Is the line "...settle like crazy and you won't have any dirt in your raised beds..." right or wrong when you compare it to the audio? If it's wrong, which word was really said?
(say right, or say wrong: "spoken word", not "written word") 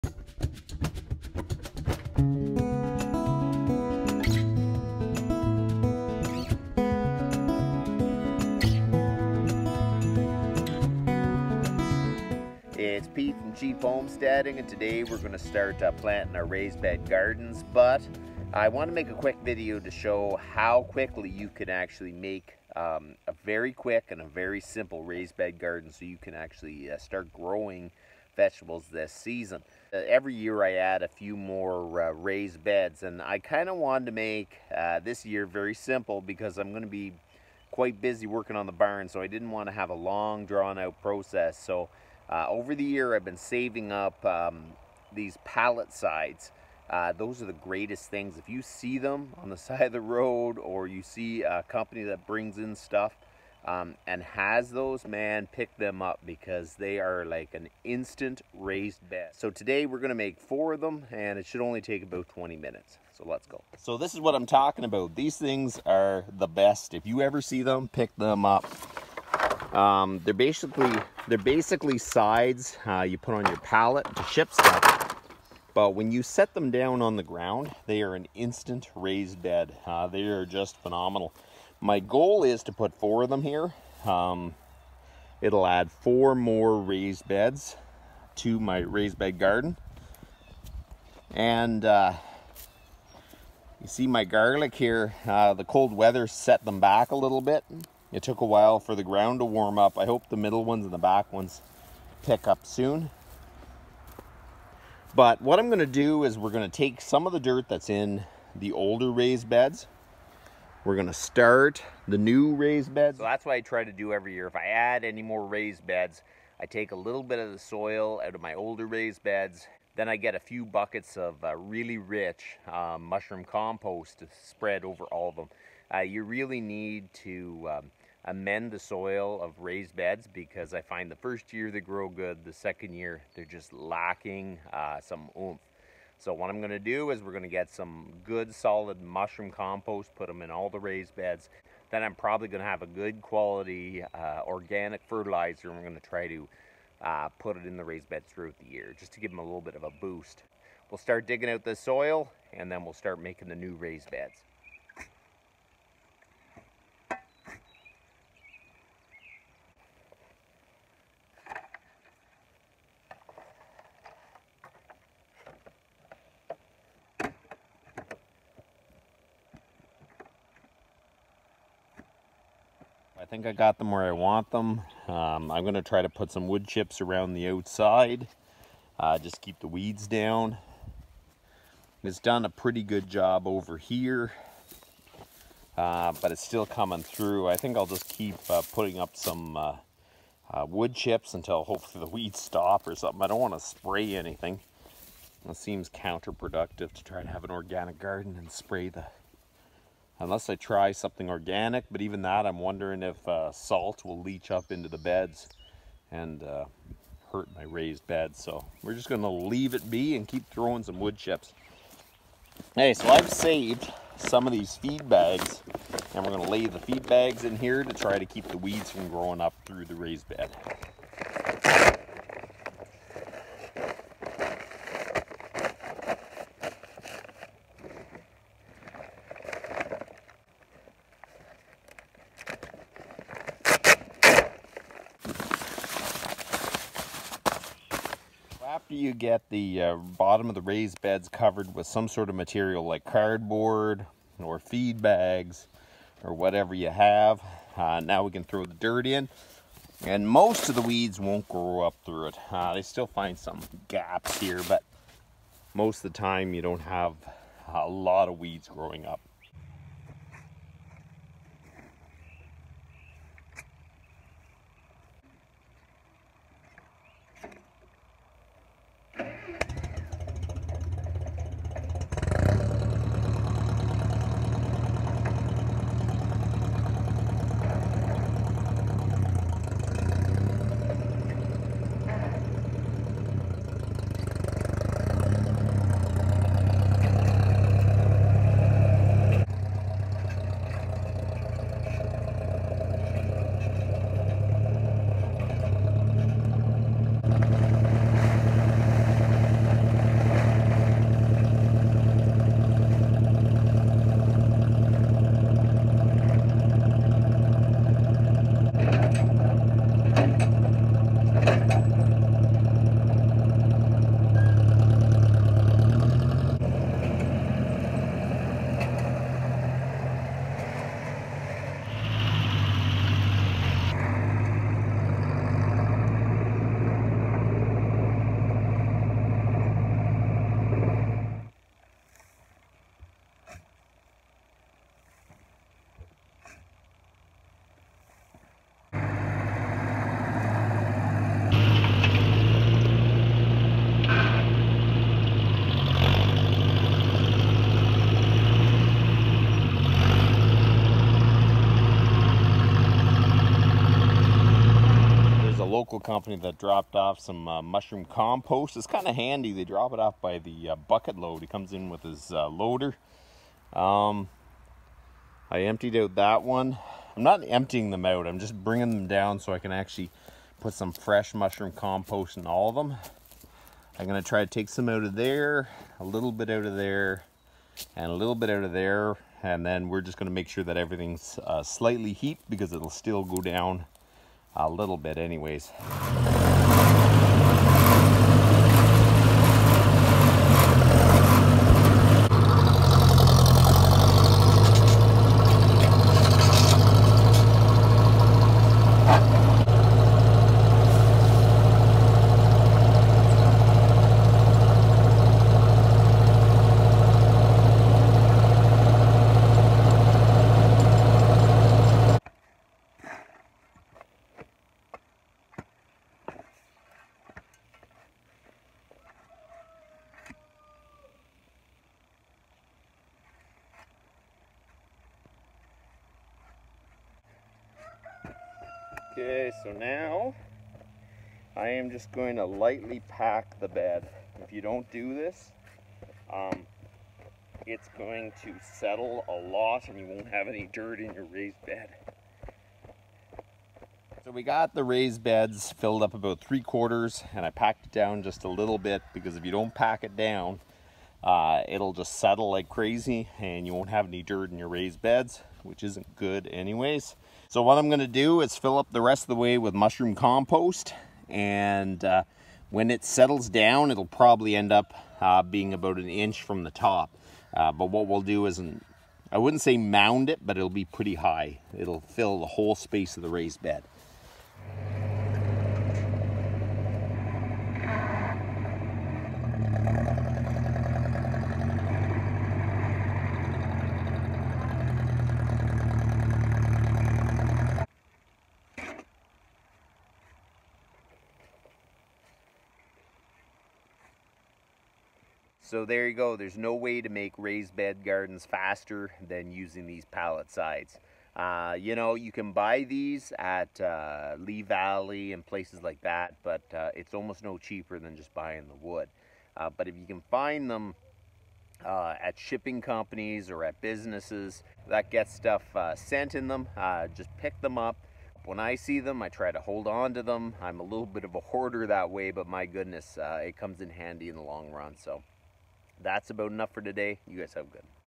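right.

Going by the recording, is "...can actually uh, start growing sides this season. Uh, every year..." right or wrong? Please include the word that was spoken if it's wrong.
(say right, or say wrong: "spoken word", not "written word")
wrong: "vegetables", not "sides".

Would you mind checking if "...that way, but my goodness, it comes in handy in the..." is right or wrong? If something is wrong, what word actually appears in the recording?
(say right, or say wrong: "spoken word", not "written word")
right.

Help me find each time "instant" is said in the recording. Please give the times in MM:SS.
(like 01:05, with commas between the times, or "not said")
00:57, 01:18.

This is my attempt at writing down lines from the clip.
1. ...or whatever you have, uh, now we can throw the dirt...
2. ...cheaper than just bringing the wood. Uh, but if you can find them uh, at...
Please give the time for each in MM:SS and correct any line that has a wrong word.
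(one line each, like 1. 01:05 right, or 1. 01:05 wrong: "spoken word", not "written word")
1. 04:06 right
2. 08:27 wrong: "buying", not "bringing".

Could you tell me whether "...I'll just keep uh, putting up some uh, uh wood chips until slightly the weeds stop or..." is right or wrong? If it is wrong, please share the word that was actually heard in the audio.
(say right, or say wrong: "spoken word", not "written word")
wrong: "hopefully", not "slightly".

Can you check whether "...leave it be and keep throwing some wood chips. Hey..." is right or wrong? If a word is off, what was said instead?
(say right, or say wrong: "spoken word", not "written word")
right.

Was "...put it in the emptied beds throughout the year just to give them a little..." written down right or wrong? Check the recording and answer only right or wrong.
wrong.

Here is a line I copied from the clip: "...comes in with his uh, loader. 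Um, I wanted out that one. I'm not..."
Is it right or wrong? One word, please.
wrong.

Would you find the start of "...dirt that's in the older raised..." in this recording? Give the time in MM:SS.
01:47.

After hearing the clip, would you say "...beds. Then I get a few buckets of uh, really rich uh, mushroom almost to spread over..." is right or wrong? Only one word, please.
wrong.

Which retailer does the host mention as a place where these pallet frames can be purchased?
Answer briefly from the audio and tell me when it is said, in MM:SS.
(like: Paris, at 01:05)
Lee Valley, at 08:24.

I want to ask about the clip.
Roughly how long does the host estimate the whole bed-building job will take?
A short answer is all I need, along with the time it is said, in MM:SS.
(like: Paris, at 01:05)
20 minutes, at 01:02.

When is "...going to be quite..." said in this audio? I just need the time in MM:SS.
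00:36.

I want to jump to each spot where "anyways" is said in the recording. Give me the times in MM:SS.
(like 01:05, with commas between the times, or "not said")
06:25, 07:36.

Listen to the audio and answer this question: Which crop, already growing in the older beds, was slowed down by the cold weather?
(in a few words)
Garlic.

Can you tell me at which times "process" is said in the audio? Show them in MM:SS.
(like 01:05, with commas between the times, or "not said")
00:41.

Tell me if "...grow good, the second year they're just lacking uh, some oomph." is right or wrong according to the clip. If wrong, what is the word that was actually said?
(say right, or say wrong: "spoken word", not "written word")
right.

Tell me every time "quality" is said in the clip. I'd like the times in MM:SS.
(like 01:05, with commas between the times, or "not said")
02:23.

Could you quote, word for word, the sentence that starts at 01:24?
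Um, it'll add four more raised beds to my raised bed garden.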